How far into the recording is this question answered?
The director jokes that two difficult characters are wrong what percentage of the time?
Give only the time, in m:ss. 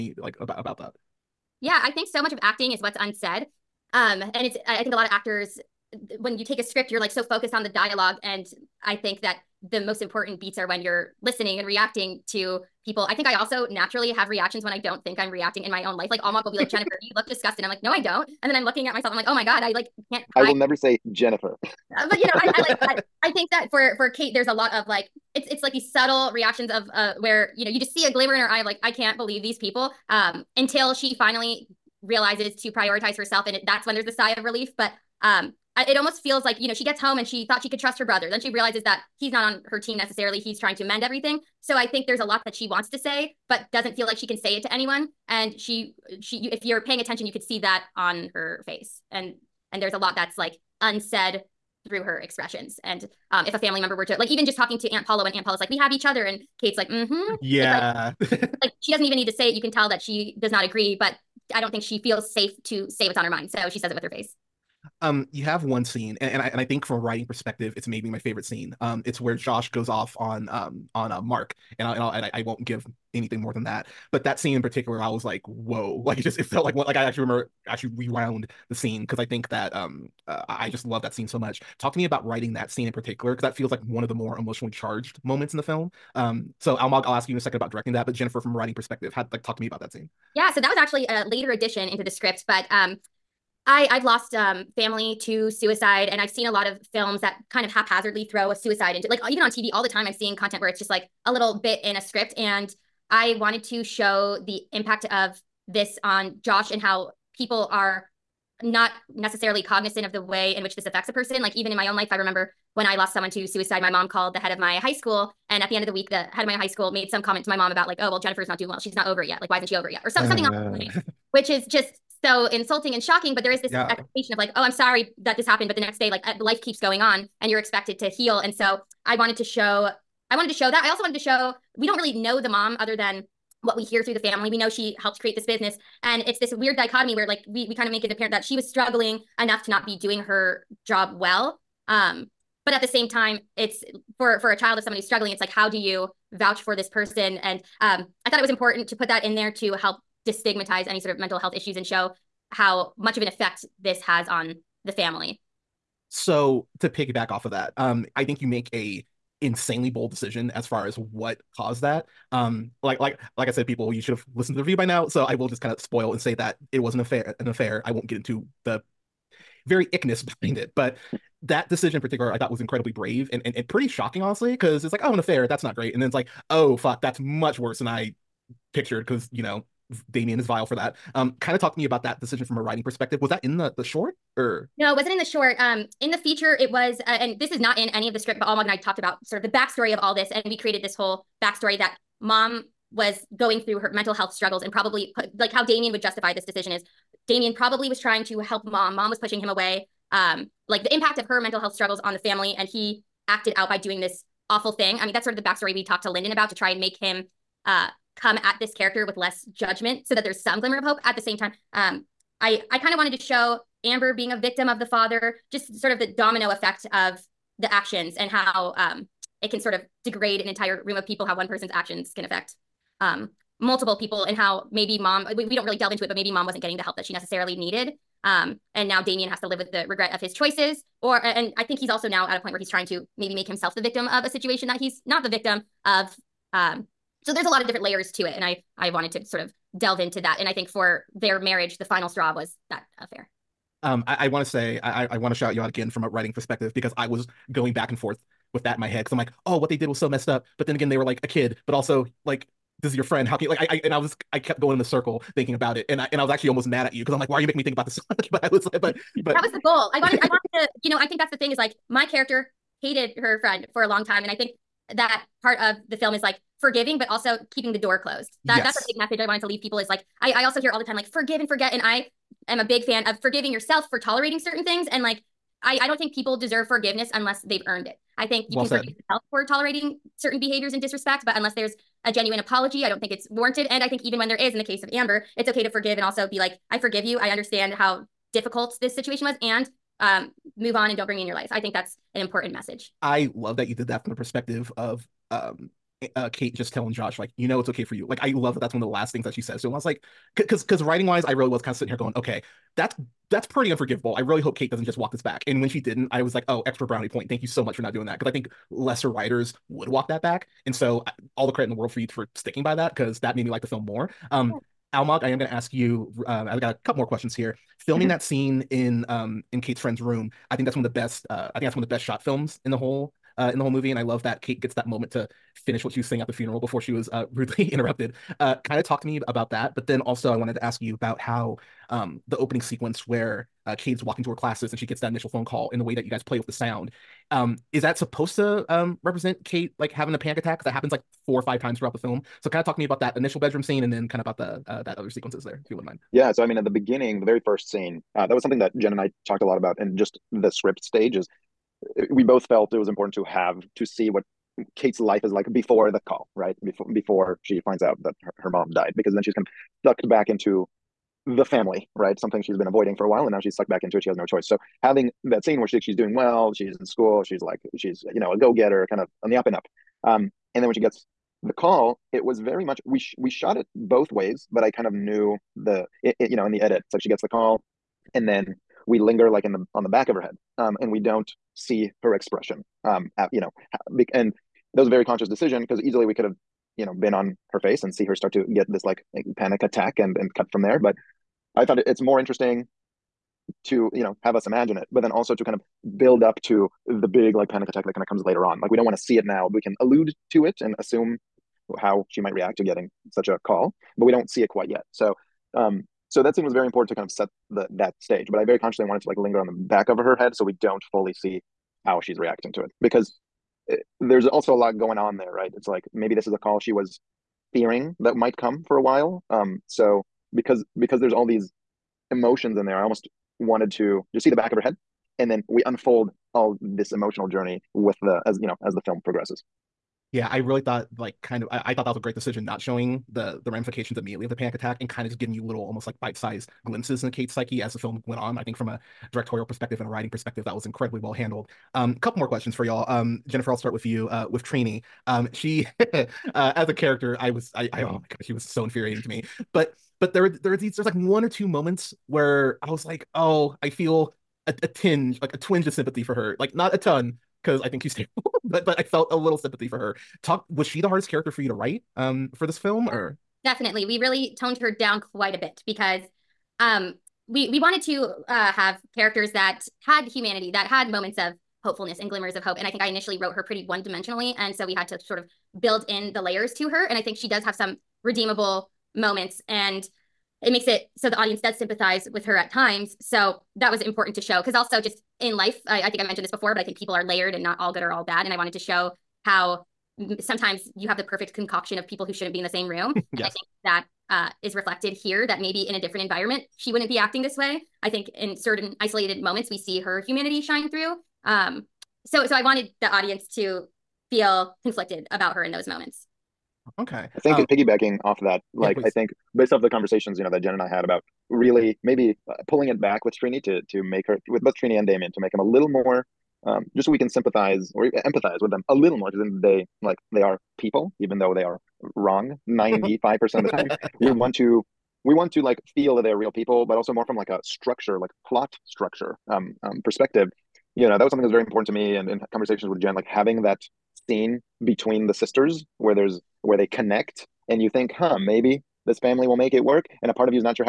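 8:42.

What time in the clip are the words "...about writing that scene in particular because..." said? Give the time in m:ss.
1:22.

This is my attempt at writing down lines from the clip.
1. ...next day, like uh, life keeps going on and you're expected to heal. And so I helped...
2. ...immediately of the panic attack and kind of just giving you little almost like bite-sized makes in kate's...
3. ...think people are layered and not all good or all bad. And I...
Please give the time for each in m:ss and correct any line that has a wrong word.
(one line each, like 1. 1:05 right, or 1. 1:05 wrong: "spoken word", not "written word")
1. 2:05 wrong: "wanted", not "helped"
2. 7:13 wrong: "glimpses", not "makes"
3. 8:06 right.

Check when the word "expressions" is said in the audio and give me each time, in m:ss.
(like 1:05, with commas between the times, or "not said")
0:52, 6:22.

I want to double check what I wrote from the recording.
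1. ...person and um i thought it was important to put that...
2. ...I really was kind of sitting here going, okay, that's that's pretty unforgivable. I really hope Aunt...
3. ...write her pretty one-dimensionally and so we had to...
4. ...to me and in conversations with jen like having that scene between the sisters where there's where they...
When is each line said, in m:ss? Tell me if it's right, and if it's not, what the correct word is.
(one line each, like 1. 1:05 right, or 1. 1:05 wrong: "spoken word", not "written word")
1. 2:26 right
2. 5:01 wrong: "Kate", not "Aunt"
3. 7:53 wrong: "wrote", not "write"
4. 8:51 right.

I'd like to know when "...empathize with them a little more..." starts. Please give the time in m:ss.
8:38.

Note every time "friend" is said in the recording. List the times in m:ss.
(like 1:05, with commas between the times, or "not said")
4:13, 4:23, 5:19.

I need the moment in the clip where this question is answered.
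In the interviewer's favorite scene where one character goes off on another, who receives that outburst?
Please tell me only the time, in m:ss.
1:11.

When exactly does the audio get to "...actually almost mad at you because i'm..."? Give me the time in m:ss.
4:16.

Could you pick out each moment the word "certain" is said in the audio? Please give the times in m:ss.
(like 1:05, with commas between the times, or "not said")
4:34, 4:40, 8:18.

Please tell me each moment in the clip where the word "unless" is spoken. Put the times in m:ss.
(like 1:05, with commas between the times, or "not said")
4:37, 4:41.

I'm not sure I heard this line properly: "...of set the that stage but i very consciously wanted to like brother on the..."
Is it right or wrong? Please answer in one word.
wrong.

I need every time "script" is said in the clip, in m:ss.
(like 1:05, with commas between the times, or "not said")
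0:06, 1:32, 1:41, 3:08, 5:50.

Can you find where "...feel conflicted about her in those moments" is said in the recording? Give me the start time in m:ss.
8:24.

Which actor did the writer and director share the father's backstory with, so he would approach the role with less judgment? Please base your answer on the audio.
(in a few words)
Lyndon.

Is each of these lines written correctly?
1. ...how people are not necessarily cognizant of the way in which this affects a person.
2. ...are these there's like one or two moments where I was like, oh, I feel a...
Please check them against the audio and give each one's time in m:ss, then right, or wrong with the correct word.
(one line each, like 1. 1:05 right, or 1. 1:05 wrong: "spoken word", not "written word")
1. 1:46 right
2. 7:30 right.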